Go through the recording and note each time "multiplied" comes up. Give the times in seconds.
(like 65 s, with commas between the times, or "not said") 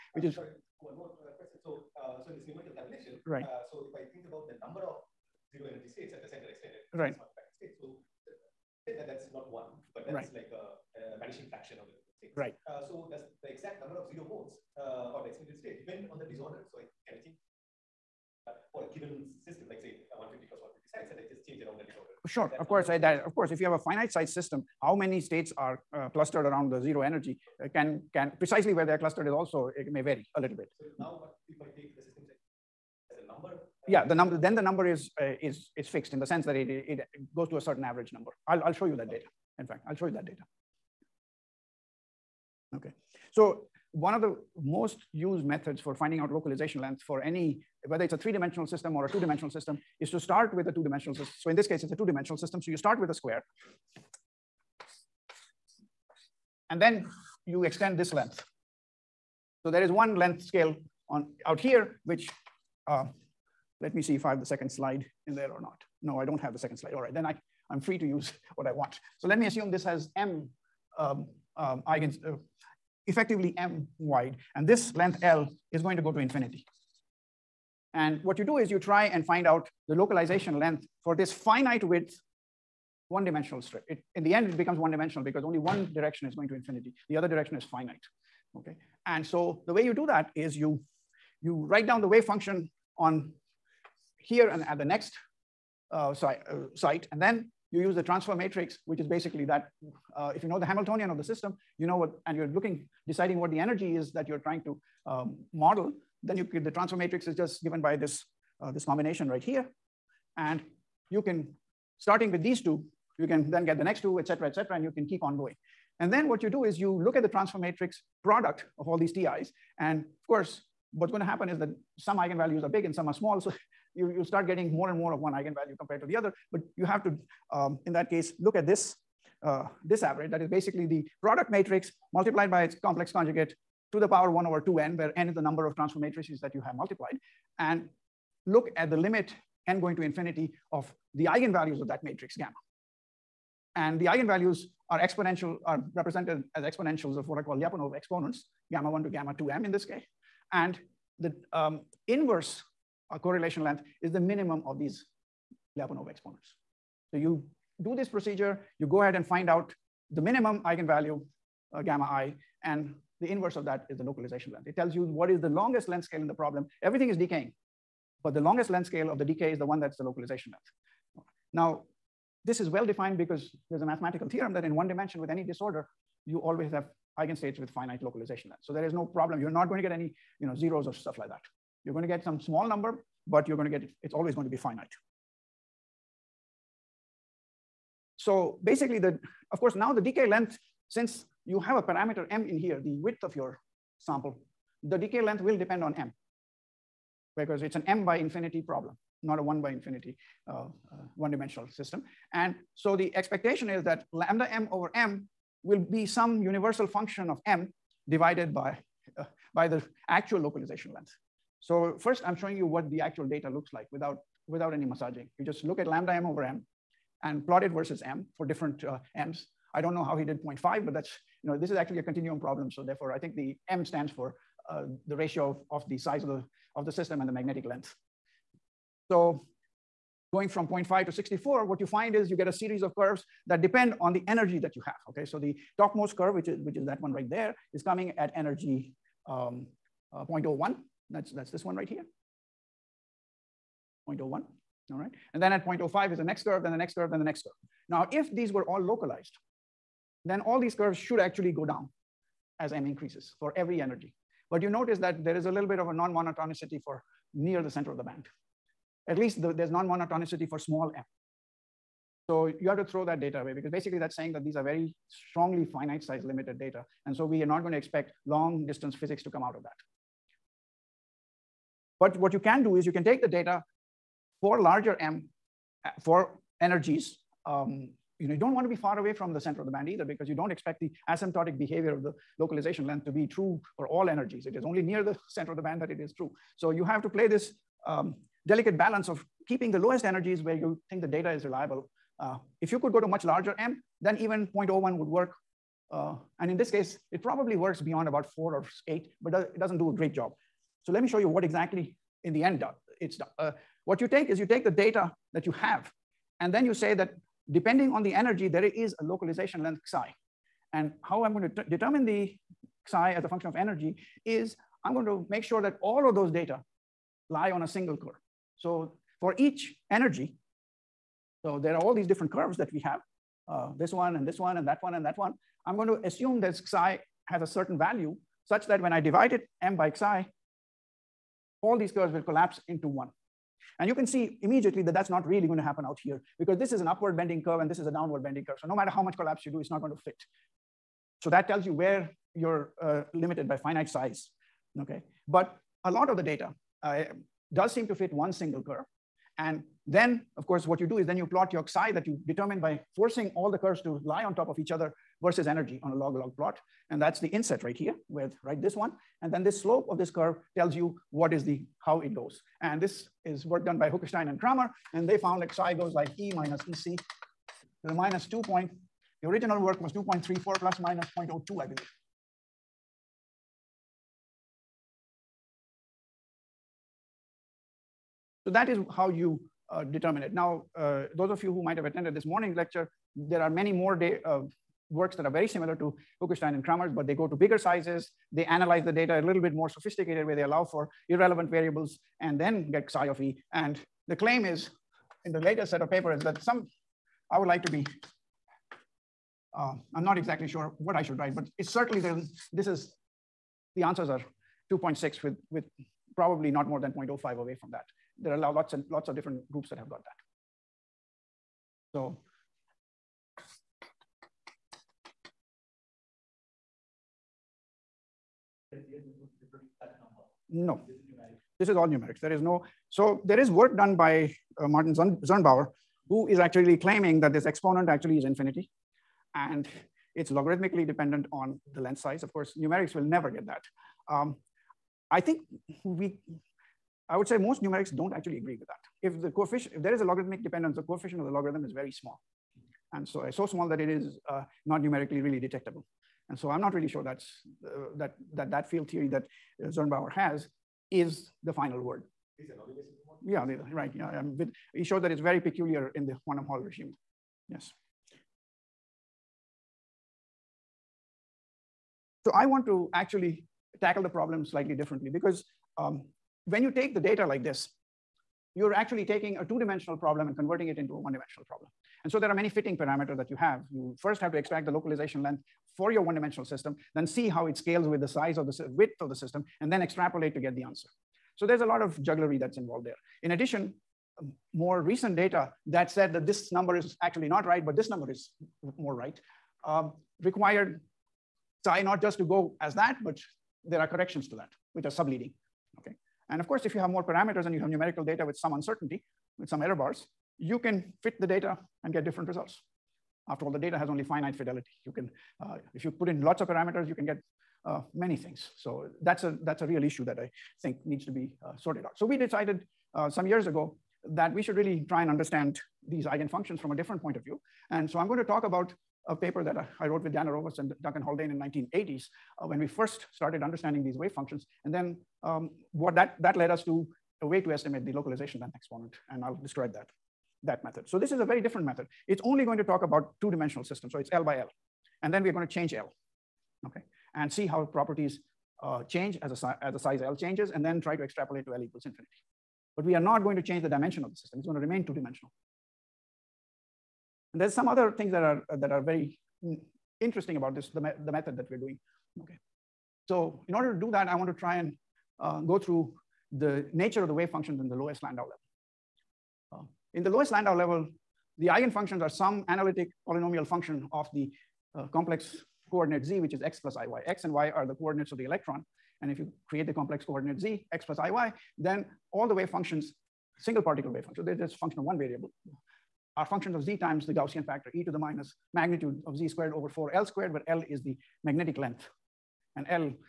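132 s, 136 s.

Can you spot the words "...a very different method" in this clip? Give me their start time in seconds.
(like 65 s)
531 s.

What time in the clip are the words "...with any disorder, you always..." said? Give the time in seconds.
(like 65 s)
175 s.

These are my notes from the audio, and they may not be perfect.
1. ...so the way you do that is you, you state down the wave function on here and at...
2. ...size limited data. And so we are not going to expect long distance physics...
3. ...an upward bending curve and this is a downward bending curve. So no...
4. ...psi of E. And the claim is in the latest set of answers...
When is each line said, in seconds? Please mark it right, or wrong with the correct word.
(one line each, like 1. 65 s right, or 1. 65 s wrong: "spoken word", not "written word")
1. 89 s wrong: "write", not "state"
2. 266 s right
3. 336 s right
4. 392 s wrong: "papers", not "answers".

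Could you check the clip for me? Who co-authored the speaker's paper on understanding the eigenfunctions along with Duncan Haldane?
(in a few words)
Dan Arovas.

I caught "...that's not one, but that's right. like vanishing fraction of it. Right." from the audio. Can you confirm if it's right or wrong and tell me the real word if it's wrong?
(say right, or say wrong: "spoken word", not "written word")
right.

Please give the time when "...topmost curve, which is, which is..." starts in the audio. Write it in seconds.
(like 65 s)
235 s.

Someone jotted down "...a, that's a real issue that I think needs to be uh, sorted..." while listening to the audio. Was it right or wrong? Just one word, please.
right.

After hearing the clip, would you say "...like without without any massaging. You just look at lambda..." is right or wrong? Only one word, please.
right.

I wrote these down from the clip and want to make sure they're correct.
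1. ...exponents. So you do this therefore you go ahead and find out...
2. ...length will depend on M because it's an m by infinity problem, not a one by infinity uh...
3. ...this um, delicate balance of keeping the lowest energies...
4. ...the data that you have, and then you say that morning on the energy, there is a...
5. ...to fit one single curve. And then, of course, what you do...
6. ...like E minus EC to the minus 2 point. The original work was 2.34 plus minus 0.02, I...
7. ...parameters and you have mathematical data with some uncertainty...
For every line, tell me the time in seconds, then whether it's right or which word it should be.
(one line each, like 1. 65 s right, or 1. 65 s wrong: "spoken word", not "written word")
1. 156 s wrong: "procedure", not "therefore"
2. 195 s right
3. 287 s right
4. 304 s wrong: "depending", not "morning"
5. 347 s right
6. 365 s right
7. 497 s wrong: "numerical", not "mathematical".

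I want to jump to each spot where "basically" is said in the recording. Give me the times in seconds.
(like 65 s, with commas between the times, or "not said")
99 s, 130 s, 188 s, 263 s.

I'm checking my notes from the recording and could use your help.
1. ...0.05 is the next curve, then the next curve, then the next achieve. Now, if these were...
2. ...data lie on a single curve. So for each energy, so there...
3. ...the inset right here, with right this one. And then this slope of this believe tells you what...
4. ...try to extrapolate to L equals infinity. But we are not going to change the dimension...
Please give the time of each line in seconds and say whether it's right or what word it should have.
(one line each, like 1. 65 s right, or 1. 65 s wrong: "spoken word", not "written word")
1. 245 s wrong: "curve", not "achieve"
2. 316 s right
3. 357 s wrong: "curve", not "believe"
4. 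540 s right.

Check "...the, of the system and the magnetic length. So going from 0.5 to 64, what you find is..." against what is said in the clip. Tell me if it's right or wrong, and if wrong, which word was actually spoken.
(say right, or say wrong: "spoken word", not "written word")
right.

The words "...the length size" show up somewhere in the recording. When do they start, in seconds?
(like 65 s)
431 s.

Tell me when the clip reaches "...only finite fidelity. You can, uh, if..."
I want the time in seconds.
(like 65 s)
503 s.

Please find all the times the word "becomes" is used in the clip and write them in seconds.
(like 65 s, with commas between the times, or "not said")
84 s.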